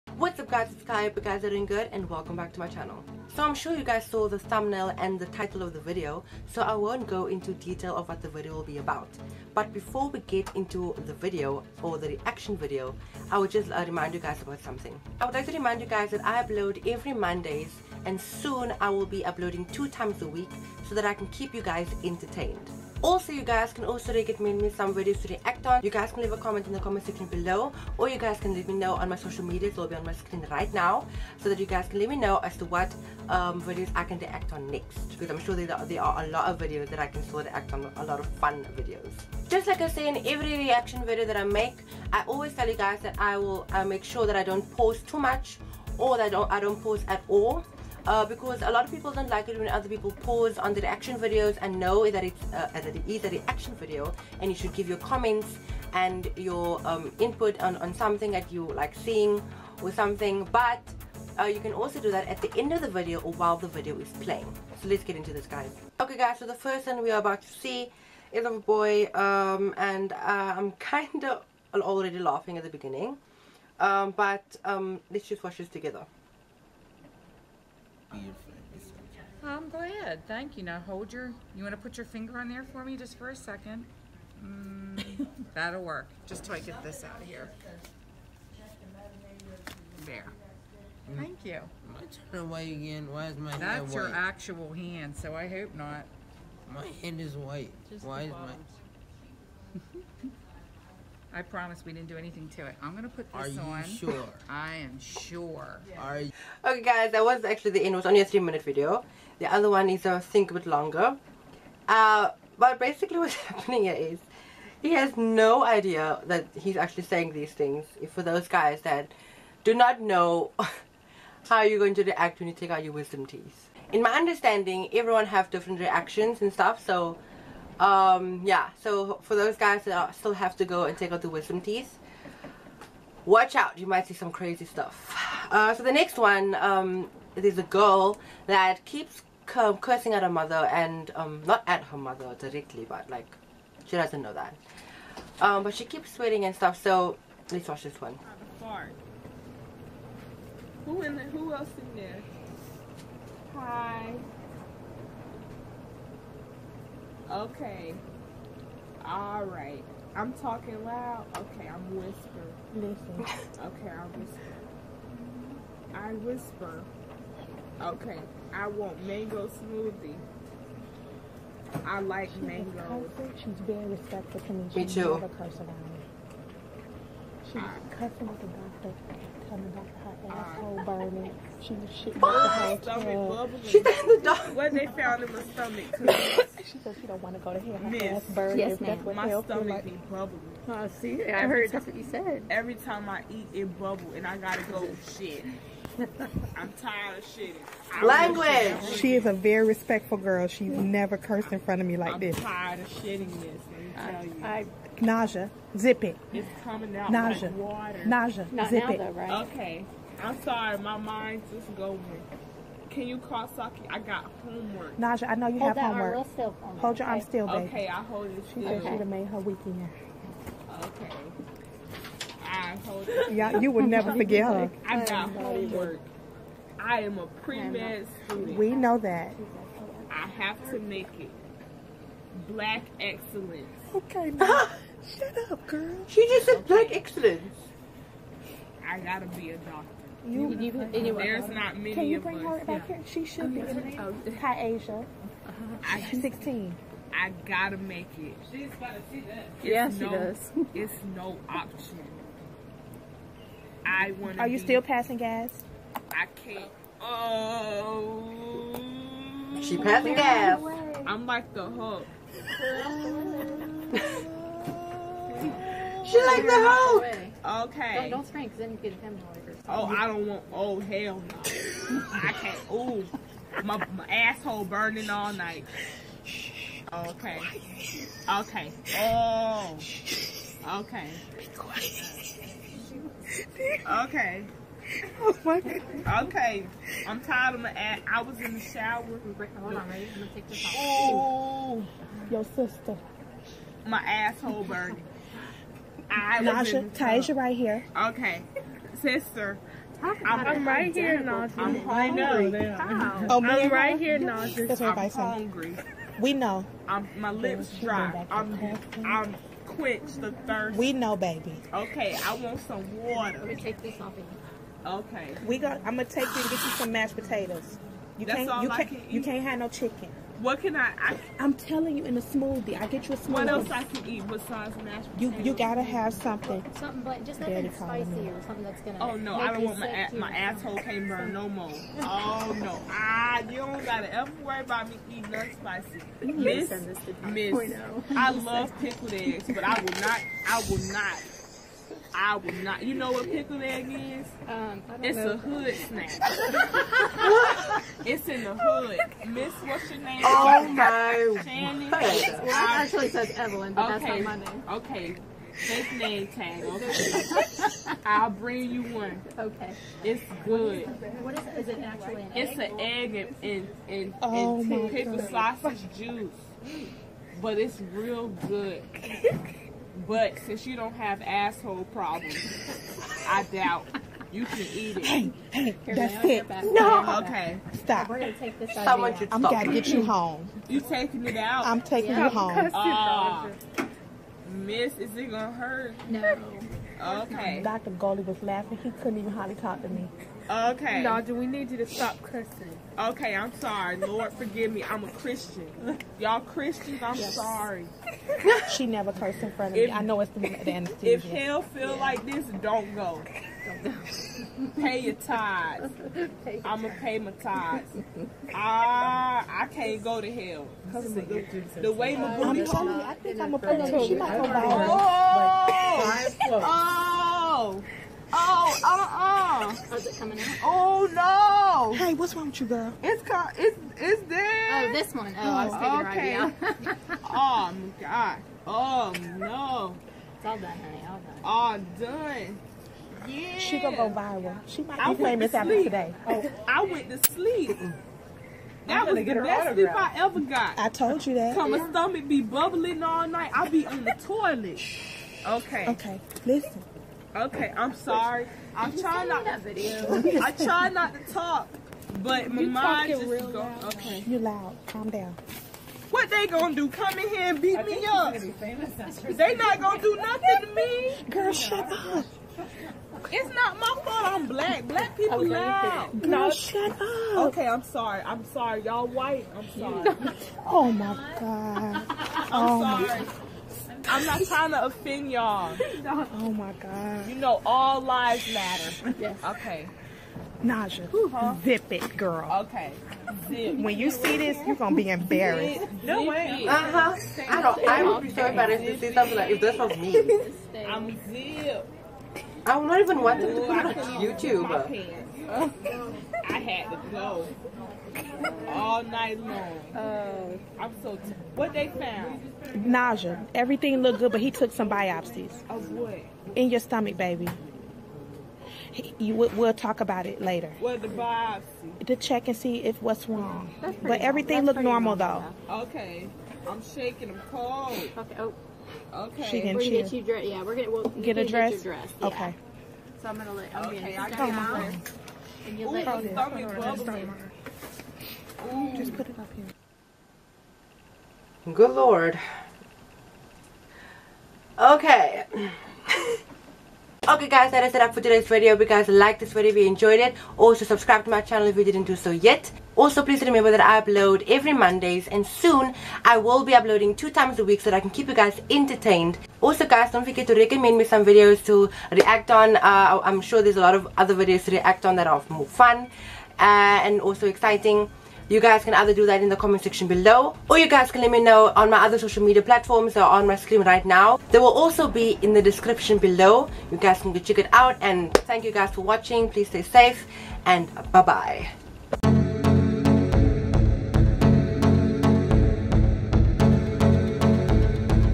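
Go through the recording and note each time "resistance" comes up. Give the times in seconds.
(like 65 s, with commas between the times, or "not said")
not said.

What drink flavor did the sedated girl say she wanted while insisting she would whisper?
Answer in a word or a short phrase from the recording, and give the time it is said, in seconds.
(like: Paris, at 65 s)
mango smoothie, at 169 s.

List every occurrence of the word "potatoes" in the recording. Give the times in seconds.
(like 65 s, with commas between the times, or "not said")
317 s, 325 s.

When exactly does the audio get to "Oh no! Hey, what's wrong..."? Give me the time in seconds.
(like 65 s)
420 s.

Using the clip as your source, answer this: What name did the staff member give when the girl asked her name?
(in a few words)
Shannon.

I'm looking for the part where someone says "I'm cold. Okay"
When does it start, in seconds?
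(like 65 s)
517 s.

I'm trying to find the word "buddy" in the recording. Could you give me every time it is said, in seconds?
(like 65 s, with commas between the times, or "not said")
not said.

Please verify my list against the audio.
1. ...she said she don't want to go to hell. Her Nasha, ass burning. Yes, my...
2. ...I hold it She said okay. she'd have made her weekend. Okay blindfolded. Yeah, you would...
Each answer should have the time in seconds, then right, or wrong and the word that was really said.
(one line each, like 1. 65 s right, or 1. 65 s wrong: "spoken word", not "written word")
1. 186 s wrong: "Miss", not "Nasha"
2. 217 s right.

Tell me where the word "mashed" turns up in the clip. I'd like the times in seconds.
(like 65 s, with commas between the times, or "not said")
316 s, 324 s.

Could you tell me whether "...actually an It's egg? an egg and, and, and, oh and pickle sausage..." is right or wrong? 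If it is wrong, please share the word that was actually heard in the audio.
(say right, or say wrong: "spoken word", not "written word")
right.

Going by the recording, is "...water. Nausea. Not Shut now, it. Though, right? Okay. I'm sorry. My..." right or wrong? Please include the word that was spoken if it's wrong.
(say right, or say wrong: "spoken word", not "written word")
wrong: "Zip", not "Shut".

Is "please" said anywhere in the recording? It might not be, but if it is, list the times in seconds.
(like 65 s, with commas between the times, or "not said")
543 s, 569 s.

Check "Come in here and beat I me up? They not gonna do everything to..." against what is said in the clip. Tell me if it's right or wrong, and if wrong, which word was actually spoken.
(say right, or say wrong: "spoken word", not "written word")
wrong: "nothing", not "everything".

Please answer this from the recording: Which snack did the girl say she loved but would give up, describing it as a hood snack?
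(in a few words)
pickled eggs.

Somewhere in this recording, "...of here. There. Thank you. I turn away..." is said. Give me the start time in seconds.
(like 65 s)
87 s.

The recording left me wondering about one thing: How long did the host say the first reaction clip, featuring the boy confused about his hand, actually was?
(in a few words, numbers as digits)
3 minutes.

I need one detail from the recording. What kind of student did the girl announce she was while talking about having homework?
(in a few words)
pre-med.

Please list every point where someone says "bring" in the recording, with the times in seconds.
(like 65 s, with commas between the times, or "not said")
242 s, 358 s.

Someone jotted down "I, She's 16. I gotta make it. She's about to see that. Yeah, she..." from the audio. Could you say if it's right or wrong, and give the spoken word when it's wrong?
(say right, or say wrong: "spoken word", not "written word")
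right.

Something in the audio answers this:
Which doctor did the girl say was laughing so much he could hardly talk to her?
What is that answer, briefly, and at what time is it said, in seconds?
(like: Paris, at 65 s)
Dr. Goldie, at 387 s.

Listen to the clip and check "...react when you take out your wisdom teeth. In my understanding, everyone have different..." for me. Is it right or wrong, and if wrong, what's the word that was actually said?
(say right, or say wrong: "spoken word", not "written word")
right.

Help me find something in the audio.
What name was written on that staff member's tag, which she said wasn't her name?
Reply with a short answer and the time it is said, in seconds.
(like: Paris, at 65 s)
Evelyn, at 353 s.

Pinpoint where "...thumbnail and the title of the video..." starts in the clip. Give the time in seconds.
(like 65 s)
4 s.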